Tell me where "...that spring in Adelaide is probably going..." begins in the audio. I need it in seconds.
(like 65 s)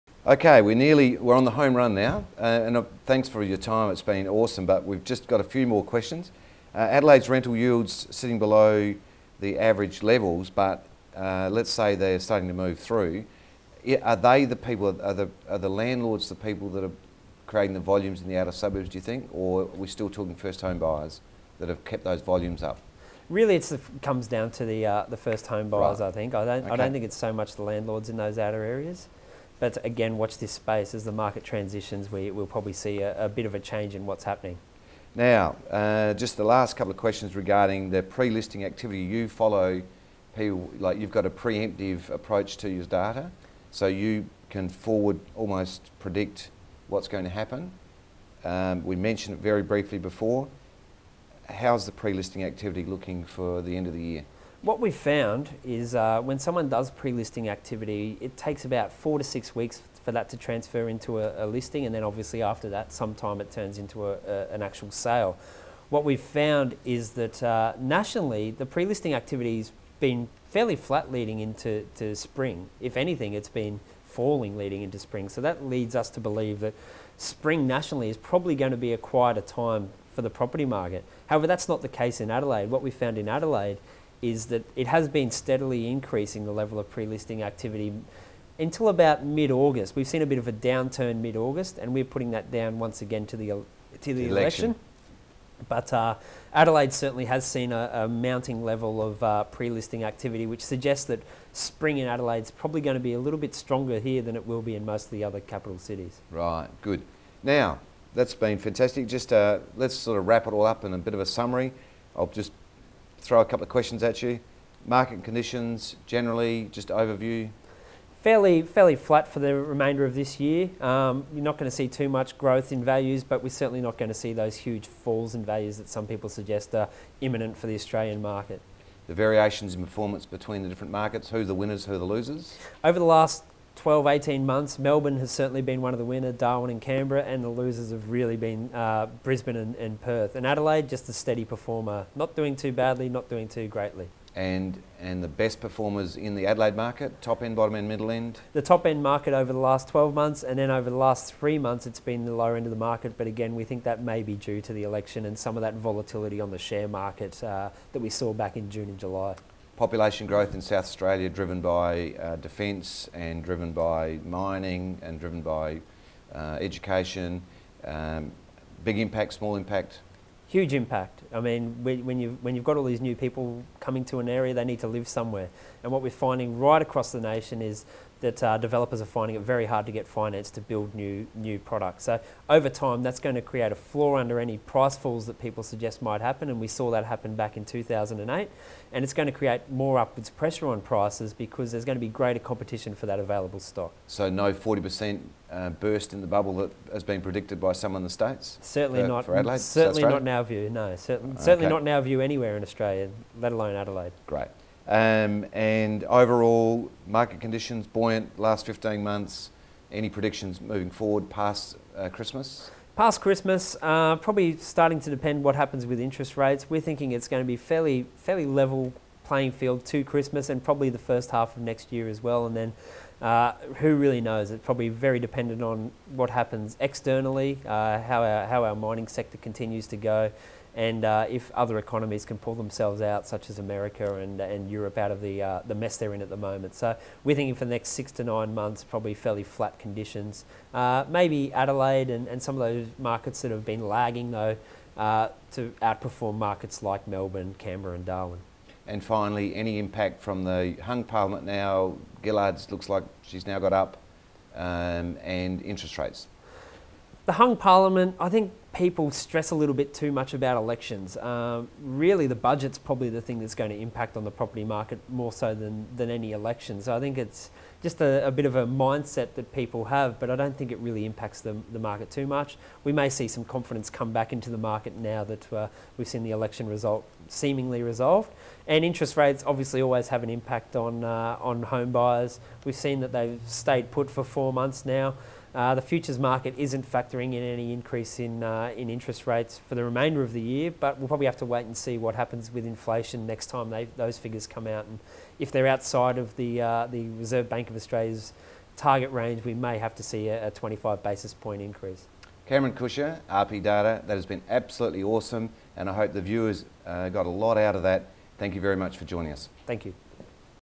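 101 s.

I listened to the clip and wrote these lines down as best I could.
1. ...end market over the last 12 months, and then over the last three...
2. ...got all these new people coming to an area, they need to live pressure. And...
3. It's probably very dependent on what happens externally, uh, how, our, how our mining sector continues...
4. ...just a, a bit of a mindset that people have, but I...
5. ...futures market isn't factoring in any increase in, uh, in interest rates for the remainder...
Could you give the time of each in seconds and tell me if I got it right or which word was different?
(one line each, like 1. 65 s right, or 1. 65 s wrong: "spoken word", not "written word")
1. 148 s right
2. 172 s wrong: "somewhere", not "pressure"
3. 224 s right
4. 267 s right
5. 285 s right.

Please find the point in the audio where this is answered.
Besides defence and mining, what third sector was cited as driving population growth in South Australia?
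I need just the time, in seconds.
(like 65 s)
166 s.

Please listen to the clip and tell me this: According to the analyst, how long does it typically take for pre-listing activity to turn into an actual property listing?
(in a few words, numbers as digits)
4 to 6 weeks.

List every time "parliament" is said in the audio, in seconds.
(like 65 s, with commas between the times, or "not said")
251 s, 257 s.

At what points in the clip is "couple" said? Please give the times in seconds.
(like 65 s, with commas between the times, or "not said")
36 s, 113 s.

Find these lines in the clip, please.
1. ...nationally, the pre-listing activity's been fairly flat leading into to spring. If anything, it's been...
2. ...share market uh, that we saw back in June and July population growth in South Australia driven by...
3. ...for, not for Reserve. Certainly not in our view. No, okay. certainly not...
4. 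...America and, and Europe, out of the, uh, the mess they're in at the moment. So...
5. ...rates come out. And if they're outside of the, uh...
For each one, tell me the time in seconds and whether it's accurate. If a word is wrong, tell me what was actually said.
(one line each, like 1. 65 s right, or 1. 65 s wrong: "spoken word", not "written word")
1. 67 s right
2. 156 s right
3. 199 s wrong: "Adelaide", not "Reserve"
4. 233 s right
5. 294 s wrong: "figures", not "rates".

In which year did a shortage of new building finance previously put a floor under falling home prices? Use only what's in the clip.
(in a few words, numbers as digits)
2008.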